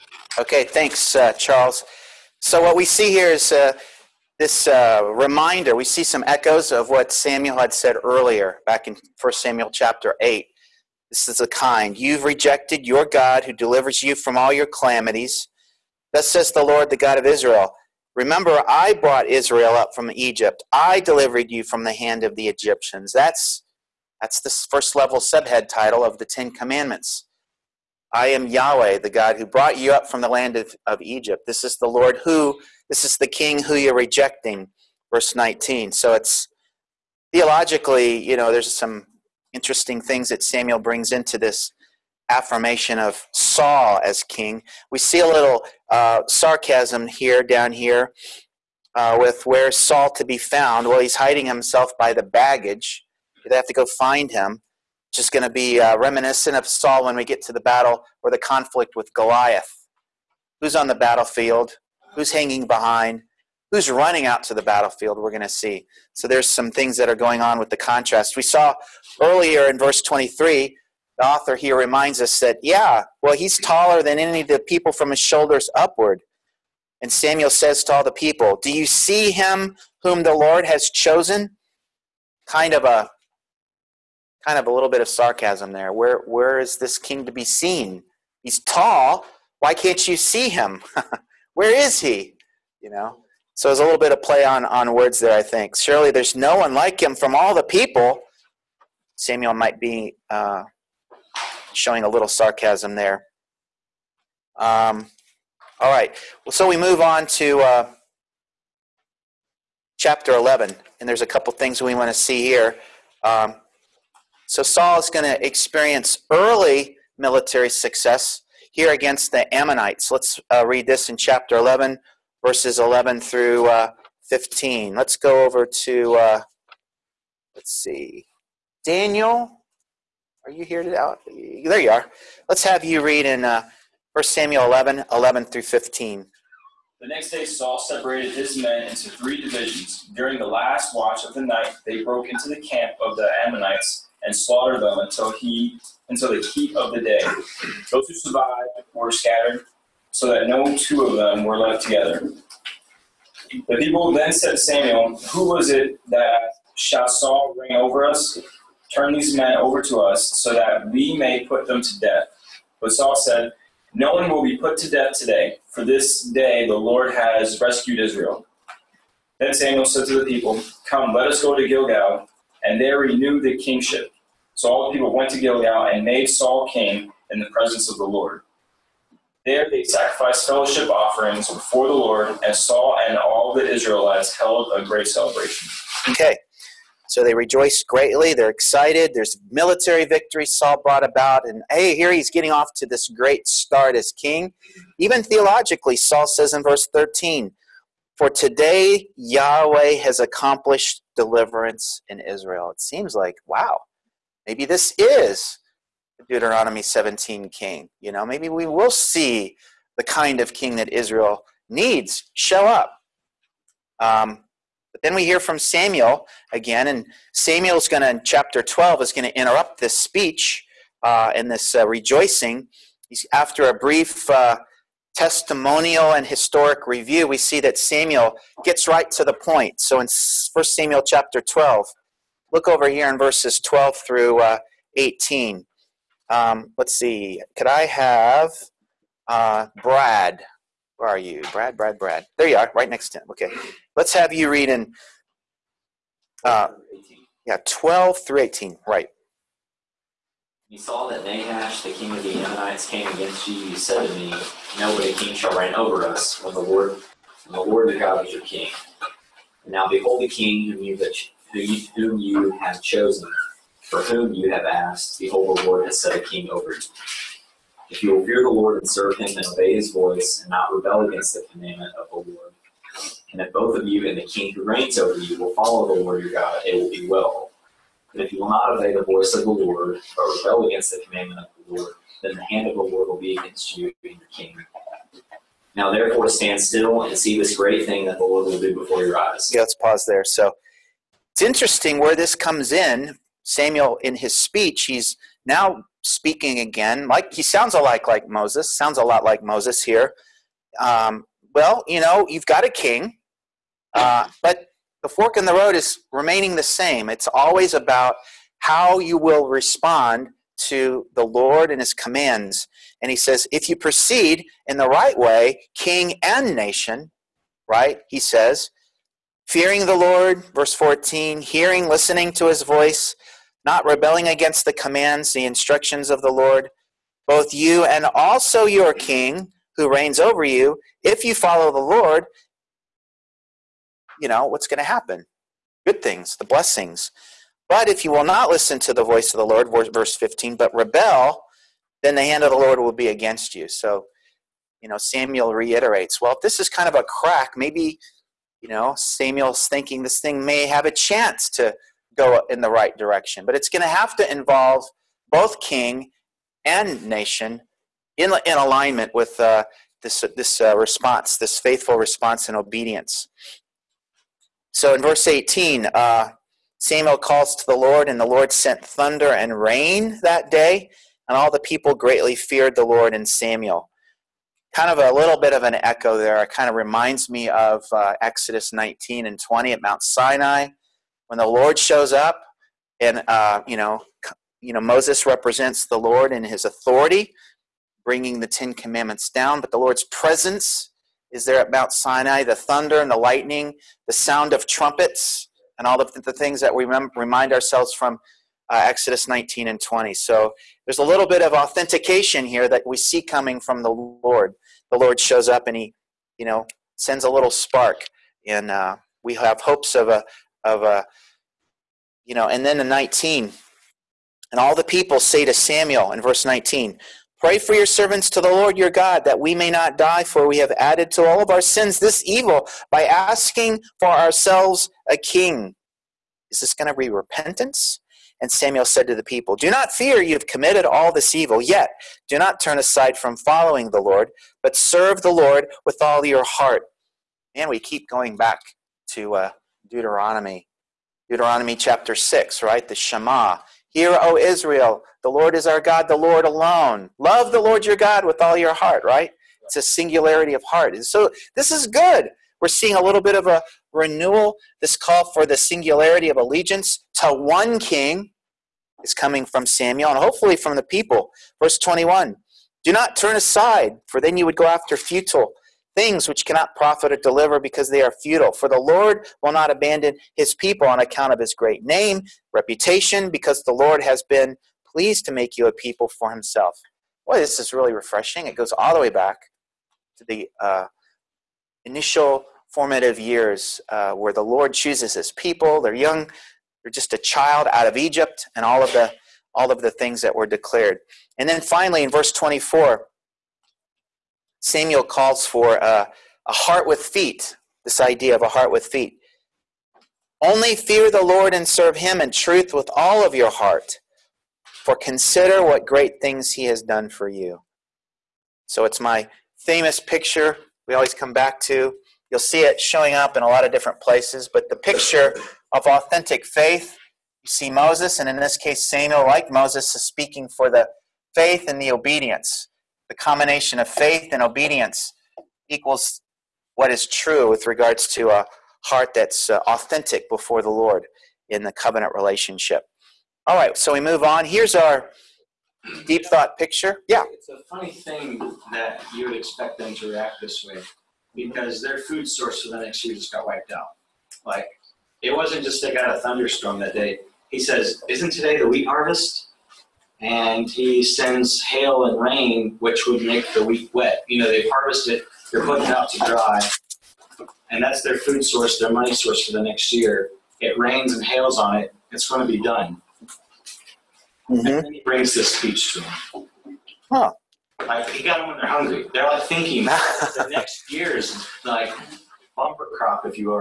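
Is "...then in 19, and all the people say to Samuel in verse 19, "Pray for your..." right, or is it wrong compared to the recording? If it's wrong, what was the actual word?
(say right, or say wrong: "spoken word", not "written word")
right.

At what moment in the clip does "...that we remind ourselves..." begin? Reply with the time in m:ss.
6:36.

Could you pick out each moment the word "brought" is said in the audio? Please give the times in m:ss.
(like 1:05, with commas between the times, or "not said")
0:18, 0:29, 3:10.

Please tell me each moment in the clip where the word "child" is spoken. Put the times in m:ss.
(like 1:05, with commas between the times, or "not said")
8:07.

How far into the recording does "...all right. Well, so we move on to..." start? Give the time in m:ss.
1:45.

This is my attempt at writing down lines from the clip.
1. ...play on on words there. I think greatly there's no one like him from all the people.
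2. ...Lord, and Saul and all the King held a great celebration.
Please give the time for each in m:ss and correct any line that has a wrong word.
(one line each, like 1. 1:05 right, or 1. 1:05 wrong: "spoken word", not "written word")
1. 1:34 wrong: "surely", not "greatly"
2. 3:01 wrong: "Israelites", not "King".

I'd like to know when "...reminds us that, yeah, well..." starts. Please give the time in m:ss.
1:11.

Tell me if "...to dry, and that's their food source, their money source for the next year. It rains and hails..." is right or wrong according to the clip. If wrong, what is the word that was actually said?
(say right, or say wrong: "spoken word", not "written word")
right.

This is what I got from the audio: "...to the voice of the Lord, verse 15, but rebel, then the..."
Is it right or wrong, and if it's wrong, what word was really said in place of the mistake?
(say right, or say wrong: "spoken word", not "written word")
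right.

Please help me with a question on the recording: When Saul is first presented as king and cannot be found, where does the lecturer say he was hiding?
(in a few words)
By the baggage.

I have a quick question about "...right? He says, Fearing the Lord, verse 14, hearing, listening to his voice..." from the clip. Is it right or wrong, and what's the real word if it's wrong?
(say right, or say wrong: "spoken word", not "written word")
right.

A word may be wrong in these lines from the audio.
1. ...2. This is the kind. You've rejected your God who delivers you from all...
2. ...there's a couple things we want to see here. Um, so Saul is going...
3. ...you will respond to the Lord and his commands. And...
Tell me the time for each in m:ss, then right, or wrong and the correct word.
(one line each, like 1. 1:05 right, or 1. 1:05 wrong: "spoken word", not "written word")
1. 0:10 wrong: "8", not "2"
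2. 1:51 right
3. 5:09 right.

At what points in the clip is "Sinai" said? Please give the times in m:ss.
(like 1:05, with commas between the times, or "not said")
6:20, 6:31.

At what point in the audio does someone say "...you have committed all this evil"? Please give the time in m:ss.
7:10.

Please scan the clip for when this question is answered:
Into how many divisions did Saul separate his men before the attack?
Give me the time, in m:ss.
2:19.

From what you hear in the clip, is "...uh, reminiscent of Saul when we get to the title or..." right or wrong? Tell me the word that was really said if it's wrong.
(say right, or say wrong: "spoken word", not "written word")
wrong: "battle", not "title".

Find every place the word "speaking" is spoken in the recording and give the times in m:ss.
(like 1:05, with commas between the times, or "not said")
4:56, 8:40.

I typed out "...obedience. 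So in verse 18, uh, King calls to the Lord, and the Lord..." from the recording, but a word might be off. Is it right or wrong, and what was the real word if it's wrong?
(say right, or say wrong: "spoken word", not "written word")
wrong: "Samuel", not "King".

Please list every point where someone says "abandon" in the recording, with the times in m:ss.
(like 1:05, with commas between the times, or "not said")
7:49.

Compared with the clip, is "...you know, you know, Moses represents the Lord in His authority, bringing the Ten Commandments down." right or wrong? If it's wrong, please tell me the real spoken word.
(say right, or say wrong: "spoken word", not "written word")
right.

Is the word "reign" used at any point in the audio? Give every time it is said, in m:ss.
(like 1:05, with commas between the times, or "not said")
2:37, 4:15, 4:34, 5:29.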